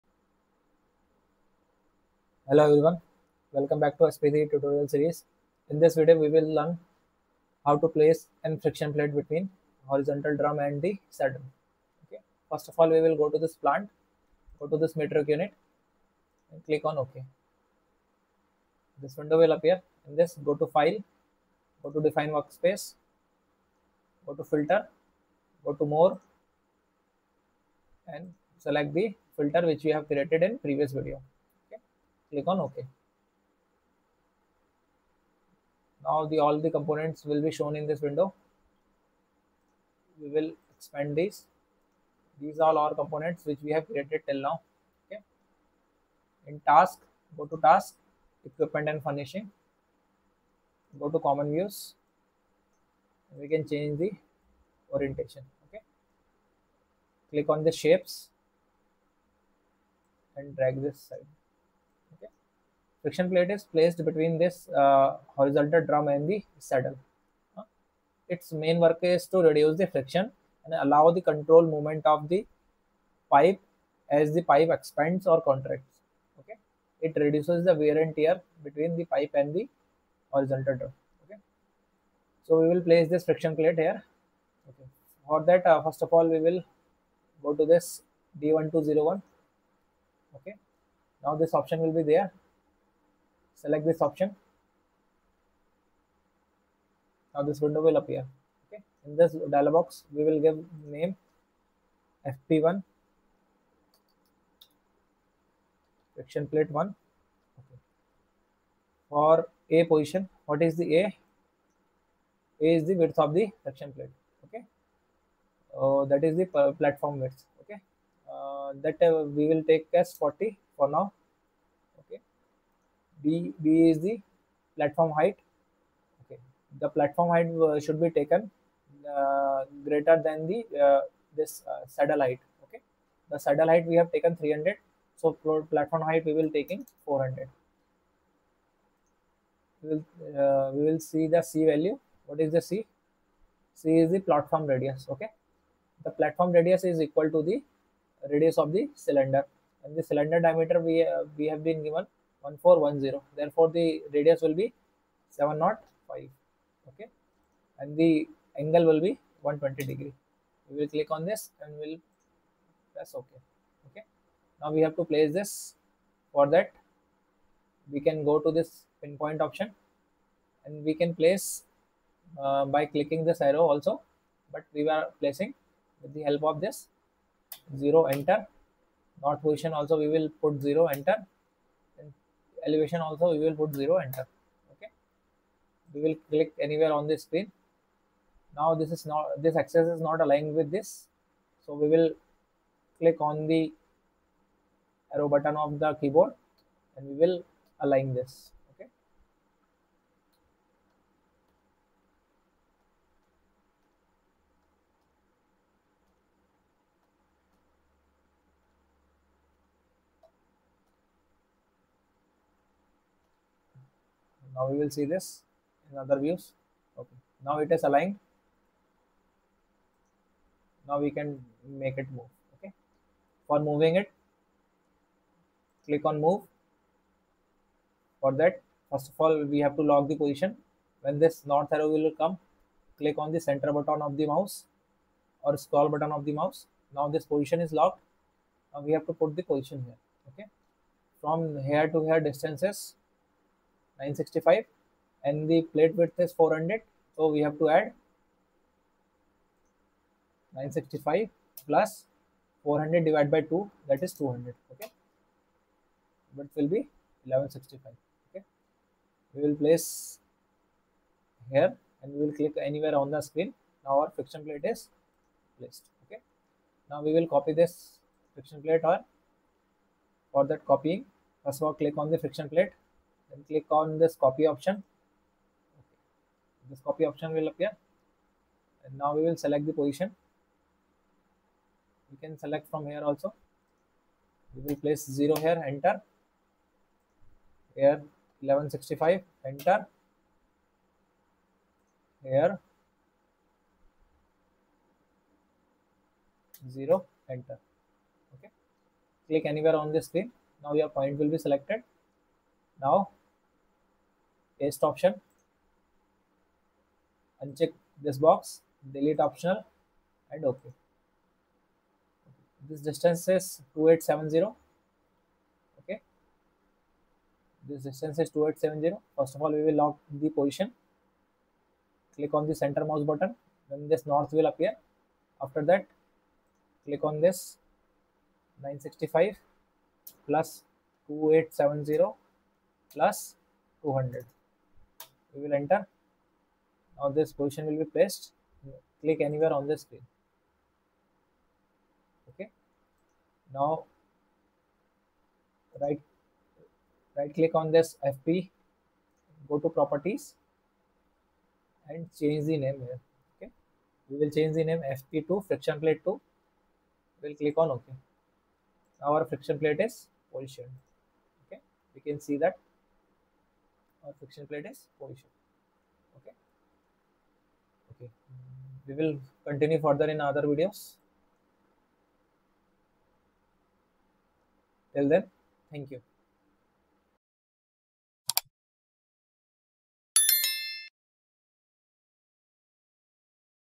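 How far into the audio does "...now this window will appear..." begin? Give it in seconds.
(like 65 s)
97 s.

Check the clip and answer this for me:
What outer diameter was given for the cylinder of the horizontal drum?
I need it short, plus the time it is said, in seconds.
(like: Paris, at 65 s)
1410, at 152 s.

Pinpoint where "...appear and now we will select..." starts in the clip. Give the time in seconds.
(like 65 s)
277 s.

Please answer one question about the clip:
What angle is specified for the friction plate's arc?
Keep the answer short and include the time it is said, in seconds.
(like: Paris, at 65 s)
120 degrees, at 159 s.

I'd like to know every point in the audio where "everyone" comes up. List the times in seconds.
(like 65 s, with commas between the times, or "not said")
2 s.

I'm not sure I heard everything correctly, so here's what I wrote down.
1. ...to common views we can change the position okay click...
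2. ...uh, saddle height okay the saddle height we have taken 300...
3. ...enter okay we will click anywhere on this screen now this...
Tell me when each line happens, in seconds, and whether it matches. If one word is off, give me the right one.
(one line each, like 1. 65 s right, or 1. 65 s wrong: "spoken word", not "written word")
1. 51 s wrong: "orientation", not "position"
2. 131 s right
3. 184 s right.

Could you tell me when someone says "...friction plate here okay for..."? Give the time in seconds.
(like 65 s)
83 s.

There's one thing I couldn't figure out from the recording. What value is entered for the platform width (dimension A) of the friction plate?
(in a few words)
40.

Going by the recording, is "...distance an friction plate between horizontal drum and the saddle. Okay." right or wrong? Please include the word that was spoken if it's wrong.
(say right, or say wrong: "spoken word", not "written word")
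wrong: "place", not "distance".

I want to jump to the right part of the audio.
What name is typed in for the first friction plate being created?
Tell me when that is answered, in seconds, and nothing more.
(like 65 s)
102 s.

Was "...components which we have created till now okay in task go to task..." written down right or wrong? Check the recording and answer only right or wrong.
right.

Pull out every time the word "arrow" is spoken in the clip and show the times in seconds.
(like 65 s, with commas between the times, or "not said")
173 s, 195 s, 231 s.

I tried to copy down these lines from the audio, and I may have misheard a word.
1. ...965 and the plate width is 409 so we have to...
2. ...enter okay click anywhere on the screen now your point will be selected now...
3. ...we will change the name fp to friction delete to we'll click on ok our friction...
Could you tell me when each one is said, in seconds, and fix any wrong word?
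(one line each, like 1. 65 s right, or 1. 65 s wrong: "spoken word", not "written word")
1. 244 s wrong: "400", not "409"
2. 297 s right
3. 354 s wrong: "plate", not "delete".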